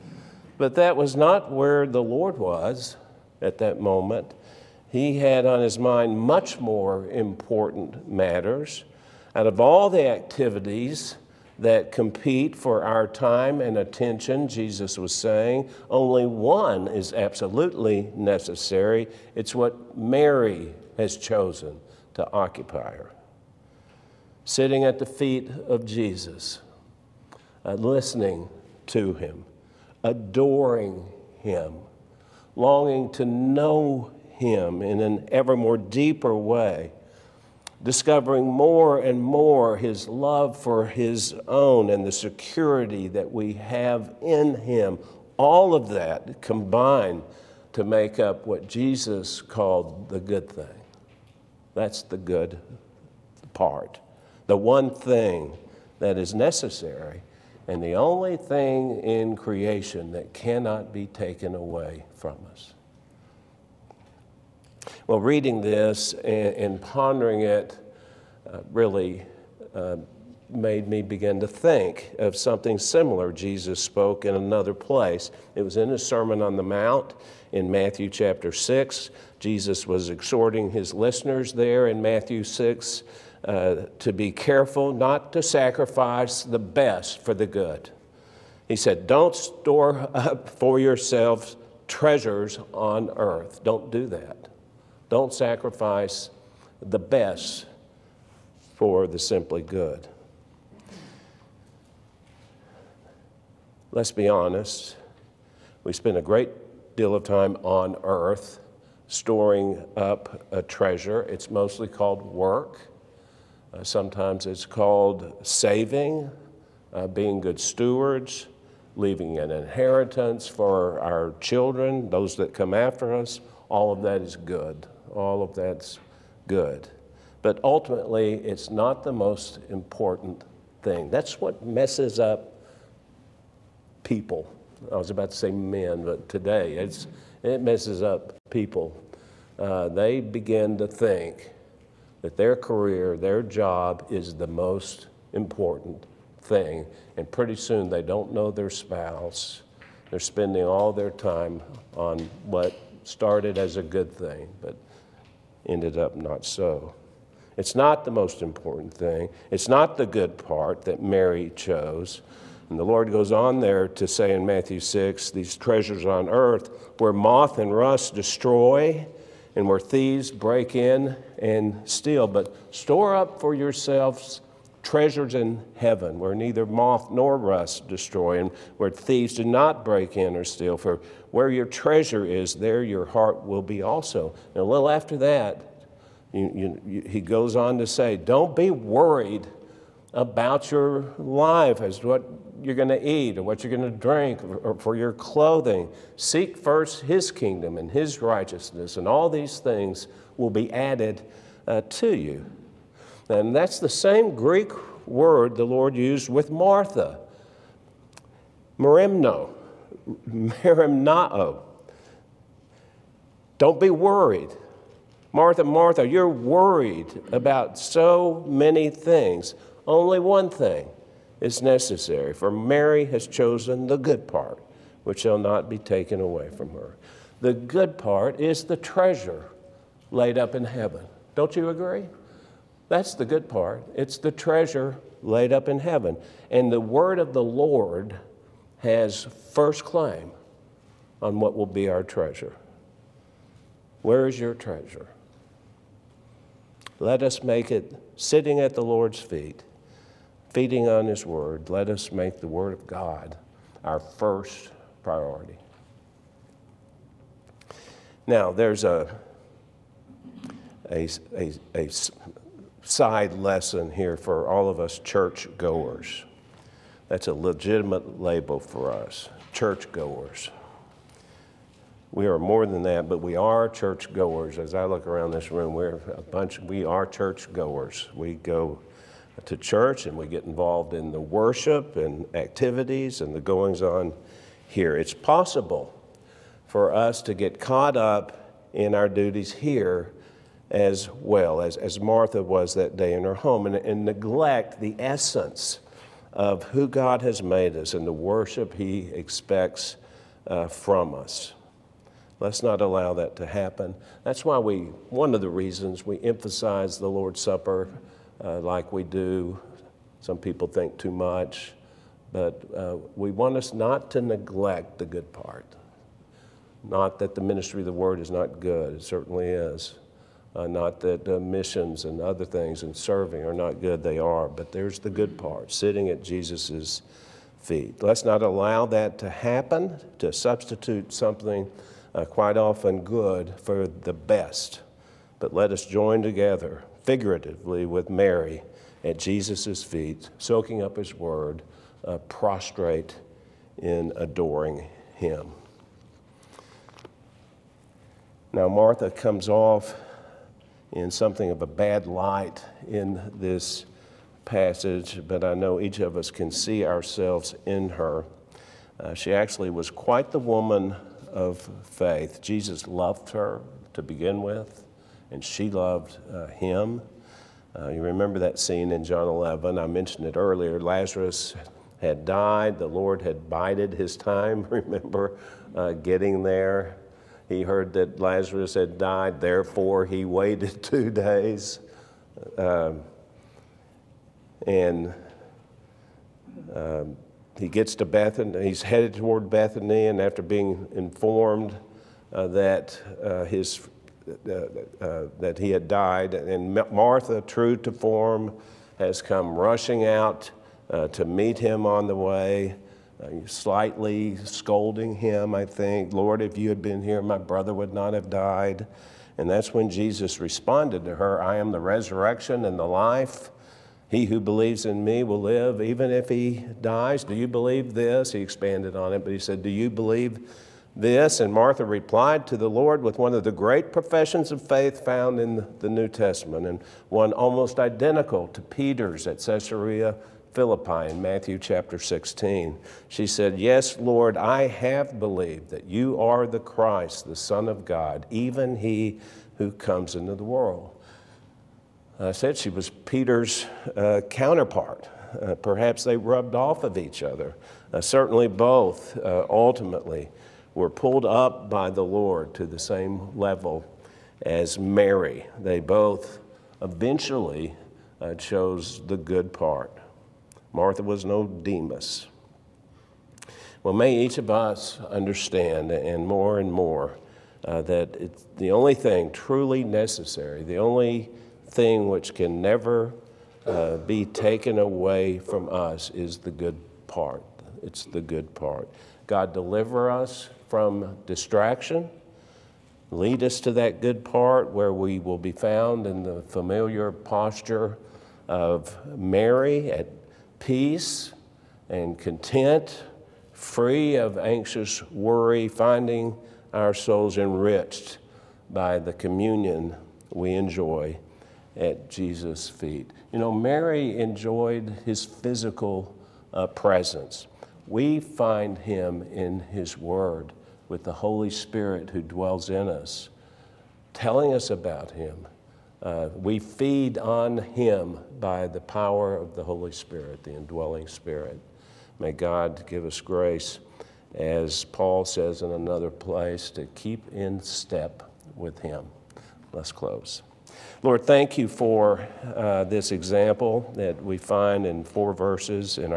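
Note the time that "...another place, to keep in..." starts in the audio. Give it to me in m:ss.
8:45.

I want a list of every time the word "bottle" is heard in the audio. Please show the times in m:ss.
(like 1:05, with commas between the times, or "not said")
not said.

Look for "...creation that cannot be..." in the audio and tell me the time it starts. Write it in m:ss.
0:59.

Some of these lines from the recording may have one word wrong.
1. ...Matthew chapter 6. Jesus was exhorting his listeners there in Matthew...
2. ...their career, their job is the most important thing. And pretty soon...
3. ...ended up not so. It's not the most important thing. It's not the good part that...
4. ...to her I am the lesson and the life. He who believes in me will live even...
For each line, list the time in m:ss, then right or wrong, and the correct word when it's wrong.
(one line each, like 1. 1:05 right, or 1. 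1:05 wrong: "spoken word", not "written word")
1. 1:17 right
2. 2:22 right
3. 2:35 right
4. 6:51 wrong: "resurrection", not "lesson".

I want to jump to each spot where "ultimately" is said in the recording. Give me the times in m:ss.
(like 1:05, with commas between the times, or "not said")
2:07, 7:29.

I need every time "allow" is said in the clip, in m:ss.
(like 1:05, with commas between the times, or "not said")
5:02, 5:28.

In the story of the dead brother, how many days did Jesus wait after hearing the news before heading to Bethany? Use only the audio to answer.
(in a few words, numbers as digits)
2.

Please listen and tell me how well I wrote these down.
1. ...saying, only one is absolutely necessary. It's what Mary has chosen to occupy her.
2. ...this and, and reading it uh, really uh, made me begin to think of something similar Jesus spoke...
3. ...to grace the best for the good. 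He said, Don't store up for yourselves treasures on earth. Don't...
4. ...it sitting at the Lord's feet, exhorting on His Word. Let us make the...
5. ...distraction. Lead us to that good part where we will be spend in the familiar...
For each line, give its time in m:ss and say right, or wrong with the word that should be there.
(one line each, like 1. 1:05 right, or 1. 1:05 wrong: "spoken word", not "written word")
1. 0:15 right
2. 1:05 wrong: "pondering", not "reading"
3. 1:25 wrong: "sacrifice", not "grace"
4. 4:07 wrong: "feeding", not "exhorting"
5. 8:01 wrong: "found", not "spend".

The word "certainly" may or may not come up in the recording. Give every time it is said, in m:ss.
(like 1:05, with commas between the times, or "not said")
5:19, 7:27.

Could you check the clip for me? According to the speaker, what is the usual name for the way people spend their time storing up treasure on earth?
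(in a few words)
Work.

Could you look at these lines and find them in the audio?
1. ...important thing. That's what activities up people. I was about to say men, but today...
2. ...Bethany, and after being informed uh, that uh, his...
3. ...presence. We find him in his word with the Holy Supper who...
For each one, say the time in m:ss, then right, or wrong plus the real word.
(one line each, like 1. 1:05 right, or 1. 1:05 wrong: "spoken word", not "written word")
1. 2:09 wrong: "messes", not "activities"
2. 6:29 right
3. 8:26 wrong: "Spirit", not "Supper".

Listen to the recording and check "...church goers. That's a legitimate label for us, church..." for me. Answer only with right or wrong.
right.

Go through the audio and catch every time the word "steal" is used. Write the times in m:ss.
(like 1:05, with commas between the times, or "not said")
2:51, 3:00.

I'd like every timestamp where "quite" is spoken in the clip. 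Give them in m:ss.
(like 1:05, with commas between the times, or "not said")
5:32, 5:59.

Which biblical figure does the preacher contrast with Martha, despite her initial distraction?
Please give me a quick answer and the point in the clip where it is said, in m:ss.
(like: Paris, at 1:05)
Demas, at 7:41.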